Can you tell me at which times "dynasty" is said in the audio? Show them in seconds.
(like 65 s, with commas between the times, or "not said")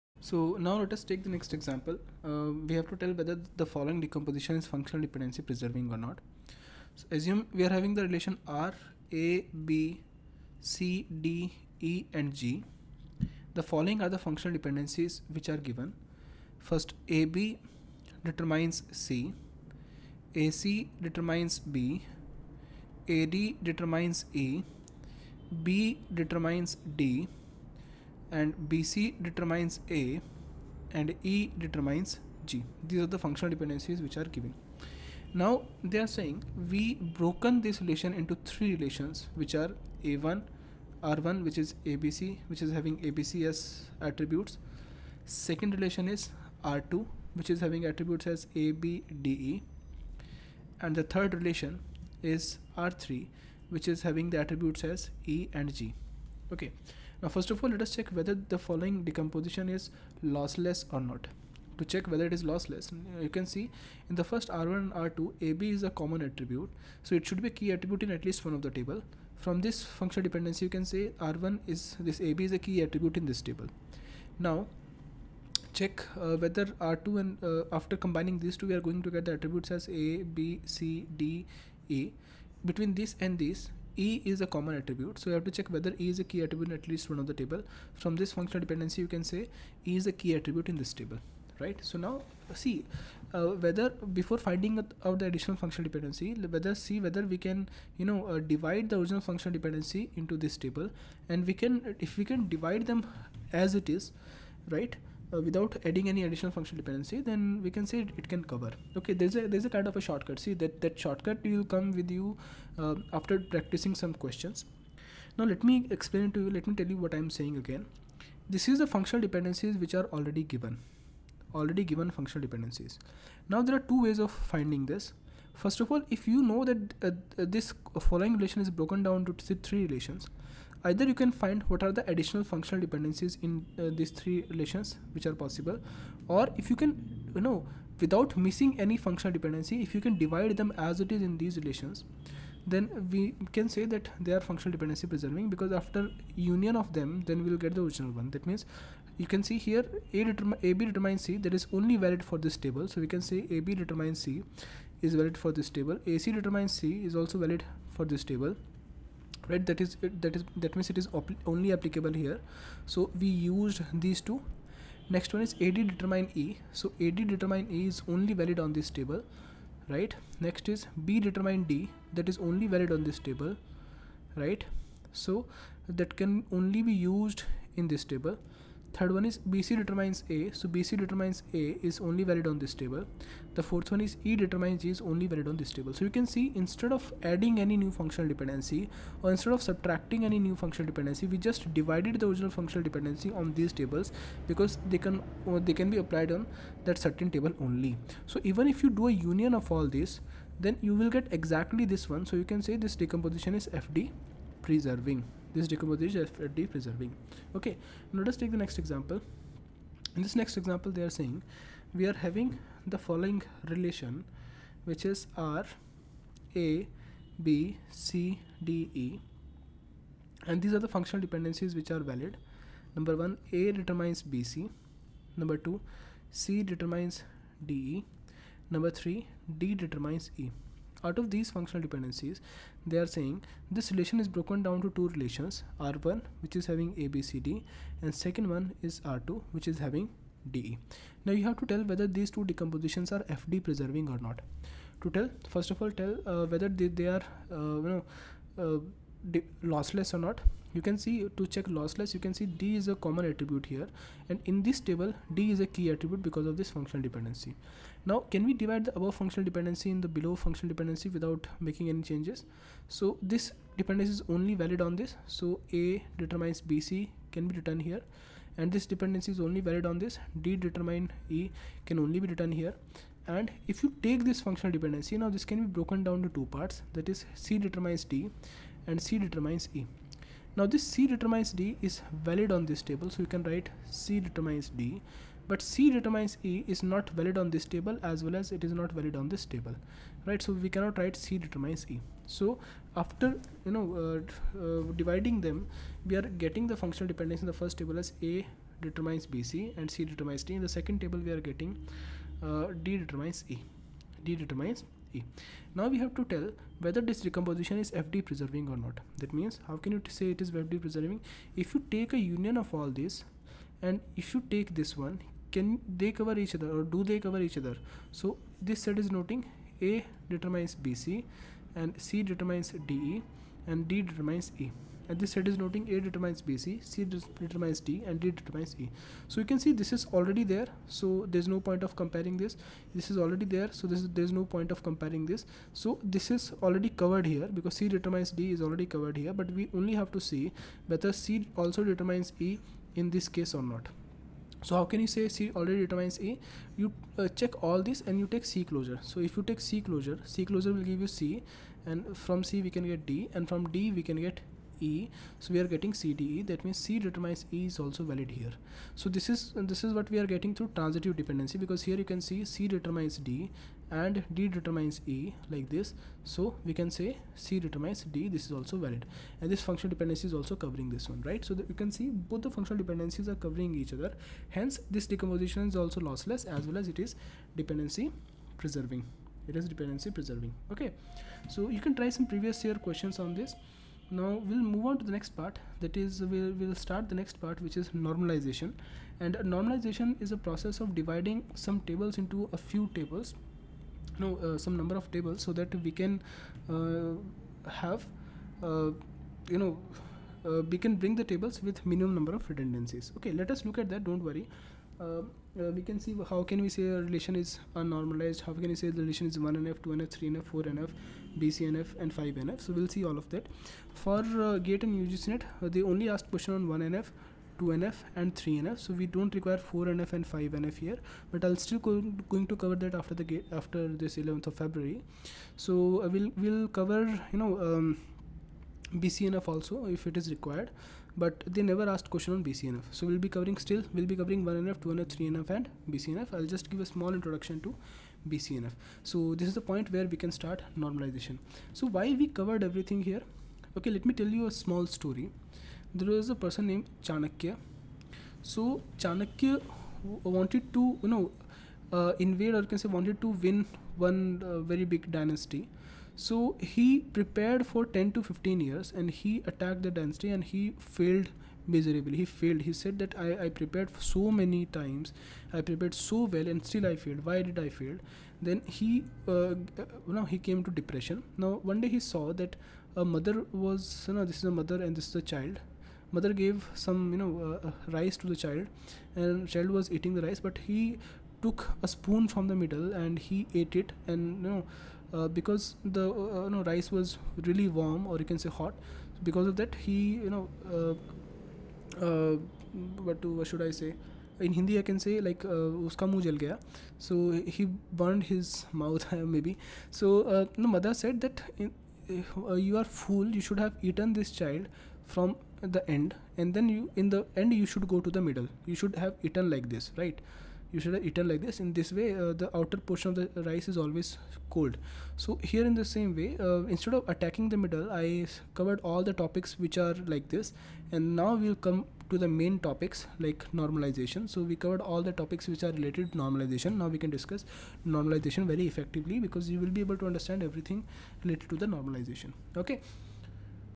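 455 s, 459 s.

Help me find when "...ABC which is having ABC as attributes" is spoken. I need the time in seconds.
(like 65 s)
41 s.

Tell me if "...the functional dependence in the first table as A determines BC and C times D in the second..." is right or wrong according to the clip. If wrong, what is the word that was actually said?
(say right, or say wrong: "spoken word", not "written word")
wrong: "determines", not "times".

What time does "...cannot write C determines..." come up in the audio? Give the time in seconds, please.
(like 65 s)
290 s.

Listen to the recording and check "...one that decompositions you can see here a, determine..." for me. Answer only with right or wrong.
wrong.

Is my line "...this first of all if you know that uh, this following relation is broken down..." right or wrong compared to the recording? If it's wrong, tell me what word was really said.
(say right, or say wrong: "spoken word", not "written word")
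right.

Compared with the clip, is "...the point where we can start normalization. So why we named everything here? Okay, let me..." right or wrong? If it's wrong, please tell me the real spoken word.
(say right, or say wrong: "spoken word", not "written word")
wrong: "covered", not "named".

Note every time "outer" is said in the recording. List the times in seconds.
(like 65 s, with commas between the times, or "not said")
512 s.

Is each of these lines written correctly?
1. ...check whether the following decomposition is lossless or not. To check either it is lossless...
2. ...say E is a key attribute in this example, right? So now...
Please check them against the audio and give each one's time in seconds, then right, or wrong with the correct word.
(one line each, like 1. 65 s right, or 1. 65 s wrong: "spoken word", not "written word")
1. 57 s wrong: "whether", not "either"
2. 89 s wrong: "table", not "example".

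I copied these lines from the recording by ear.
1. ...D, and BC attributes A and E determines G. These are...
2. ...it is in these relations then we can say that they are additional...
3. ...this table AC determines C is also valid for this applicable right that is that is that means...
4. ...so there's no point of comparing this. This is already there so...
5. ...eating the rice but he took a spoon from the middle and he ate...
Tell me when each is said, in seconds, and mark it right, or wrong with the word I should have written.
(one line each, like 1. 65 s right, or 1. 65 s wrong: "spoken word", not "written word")
1. 26 s wrong: "determines", not "attributes"
2. 141 s wrong: "functional", not "additional"
3. 155 s wrong: "table", not "applicable"
4. 330 s right
5. 479 s right.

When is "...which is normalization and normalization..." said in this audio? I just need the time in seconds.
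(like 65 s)
387 s.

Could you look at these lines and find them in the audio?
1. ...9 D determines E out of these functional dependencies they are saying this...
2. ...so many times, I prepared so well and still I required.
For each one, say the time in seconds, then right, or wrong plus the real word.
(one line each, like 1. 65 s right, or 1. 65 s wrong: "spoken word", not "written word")
1. 228 s wrong: "3", not "9"
2. 463 s wrong: "failed", not "required".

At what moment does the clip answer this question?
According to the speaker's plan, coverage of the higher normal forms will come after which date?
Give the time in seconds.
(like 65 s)
424 s.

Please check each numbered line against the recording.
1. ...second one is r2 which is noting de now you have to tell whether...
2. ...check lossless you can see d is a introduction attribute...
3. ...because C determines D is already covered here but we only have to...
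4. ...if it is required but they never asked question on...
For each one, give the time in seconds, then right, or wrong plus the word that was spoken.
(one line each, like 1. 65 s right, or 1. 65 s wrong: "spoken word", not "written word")
1. 238 s wrong: "having", not "noting"
2. 251 s wrong: "common", not "introduction"
3. 337 s right
4. 429 s right.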